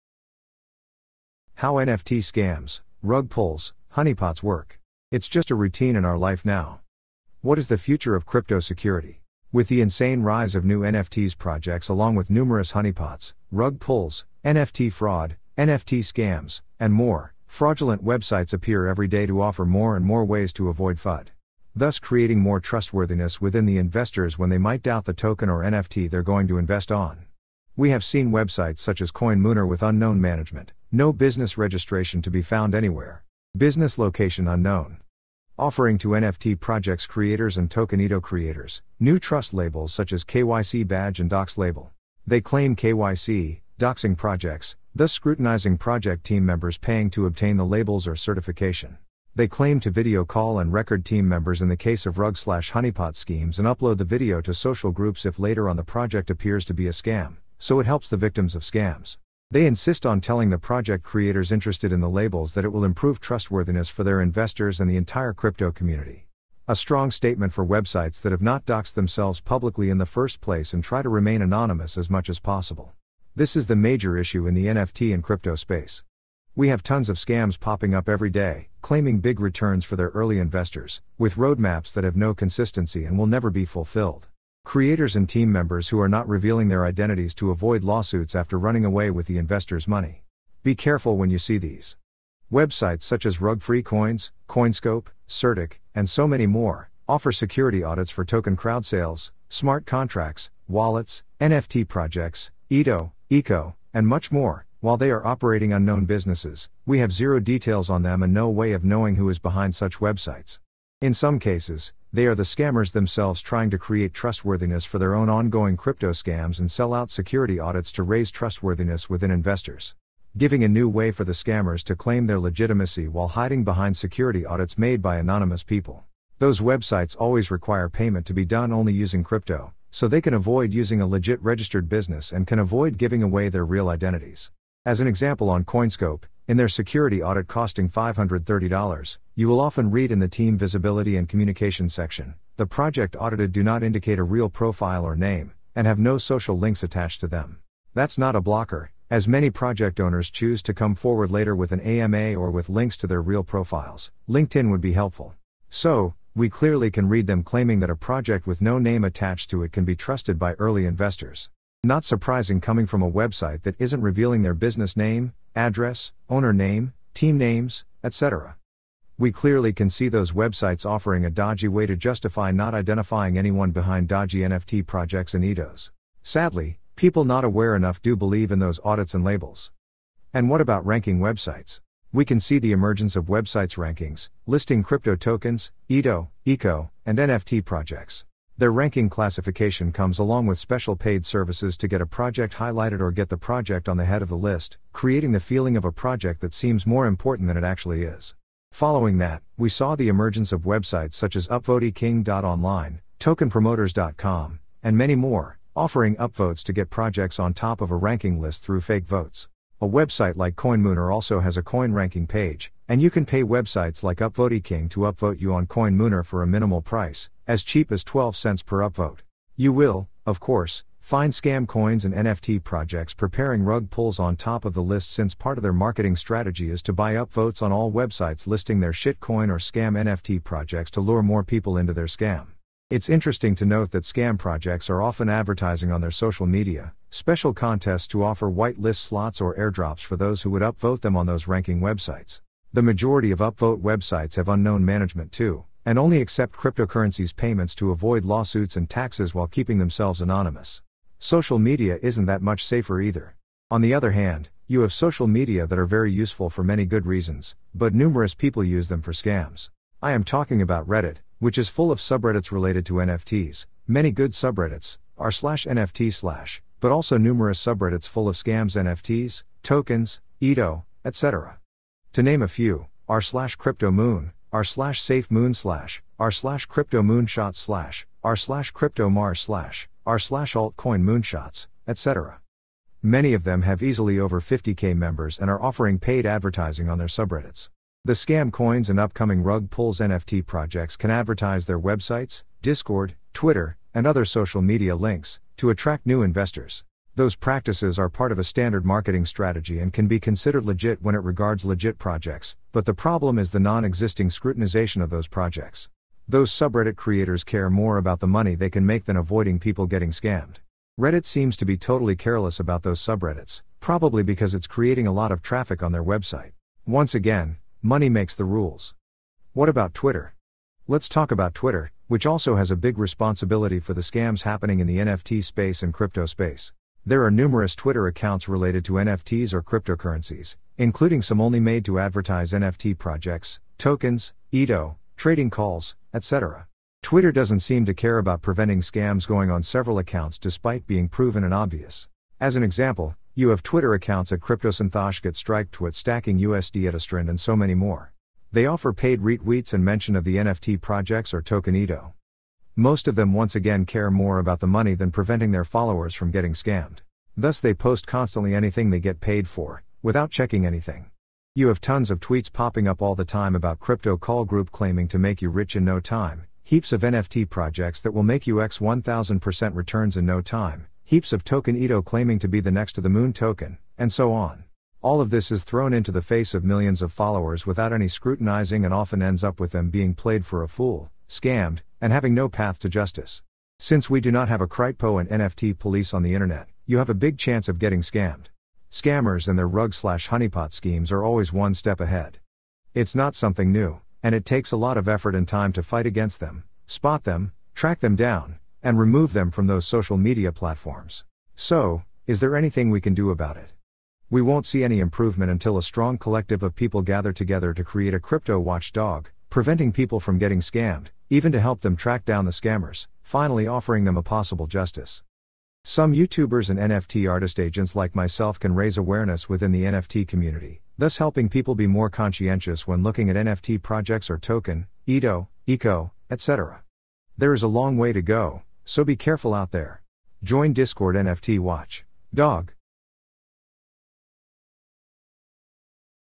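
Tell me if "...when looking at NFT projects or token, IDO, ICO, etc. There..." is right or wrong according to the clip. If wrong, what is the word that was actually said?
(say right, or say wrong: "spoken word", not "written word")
right.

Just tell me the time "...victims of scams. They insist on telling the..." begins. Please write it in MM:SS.
00:58.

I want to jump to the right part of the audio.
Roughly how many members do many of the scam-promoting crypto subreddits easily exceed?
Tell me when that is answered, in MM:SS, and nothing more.
04:44.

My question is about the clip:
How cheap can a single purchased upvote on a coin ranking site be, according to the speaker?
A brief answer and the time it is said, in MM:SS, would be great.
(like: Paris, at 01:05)
12 cents, at 03:38.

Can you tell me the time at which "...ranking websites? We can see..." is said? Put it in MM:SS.
03:00.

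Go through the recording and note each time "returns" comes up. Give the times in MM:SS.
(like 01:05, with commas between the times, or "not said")
01:19, 06:09.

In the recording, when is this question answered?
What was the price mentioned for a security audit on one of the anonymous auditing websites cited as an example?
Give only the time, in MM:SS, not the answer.
02:17.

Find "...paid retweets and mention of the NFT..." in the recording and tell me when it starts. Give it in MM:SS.
05:48.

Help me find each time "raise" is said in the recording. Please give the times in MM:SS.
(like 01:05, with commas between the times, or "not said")
01:58, 06:58.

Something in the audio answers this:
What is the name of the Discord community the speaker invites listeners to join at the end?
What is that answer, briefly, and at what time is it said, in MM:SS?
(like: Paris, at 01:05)
NFT Watch Dog, at 07:11.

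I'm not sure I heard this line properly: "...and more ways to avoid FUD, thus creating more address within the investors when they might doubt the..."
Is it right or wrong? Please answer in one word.
wrong.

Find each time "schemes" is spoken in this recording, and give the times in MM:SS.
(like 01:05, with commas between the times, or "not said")
00:53, 06:30.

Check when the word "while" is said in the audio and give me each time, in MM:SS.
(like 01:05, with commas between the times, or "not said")
01:44, 02:03, 04:09.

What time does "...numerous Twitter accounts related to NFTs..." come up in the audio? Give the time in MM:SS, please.
05:27.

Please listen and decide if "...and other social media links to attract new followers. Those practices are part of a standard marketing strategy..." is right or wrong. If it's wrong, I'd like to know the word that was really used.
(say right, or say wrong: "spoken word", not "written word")
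wrong: "investors", not "followers".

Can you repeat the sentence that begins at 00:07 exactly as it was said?
What is the future of crypto security?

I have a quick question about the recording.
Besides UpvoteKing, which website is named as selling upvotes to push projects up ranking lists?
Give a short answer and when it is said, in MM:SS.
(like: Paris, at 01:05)
TokenPromoters.com, at 03:23.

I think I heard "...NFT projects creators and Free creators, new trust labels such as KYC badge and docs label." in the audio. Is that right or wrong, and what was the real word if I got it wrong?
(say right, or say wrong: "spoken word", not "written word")
wrong: "Tokenito", not "Free".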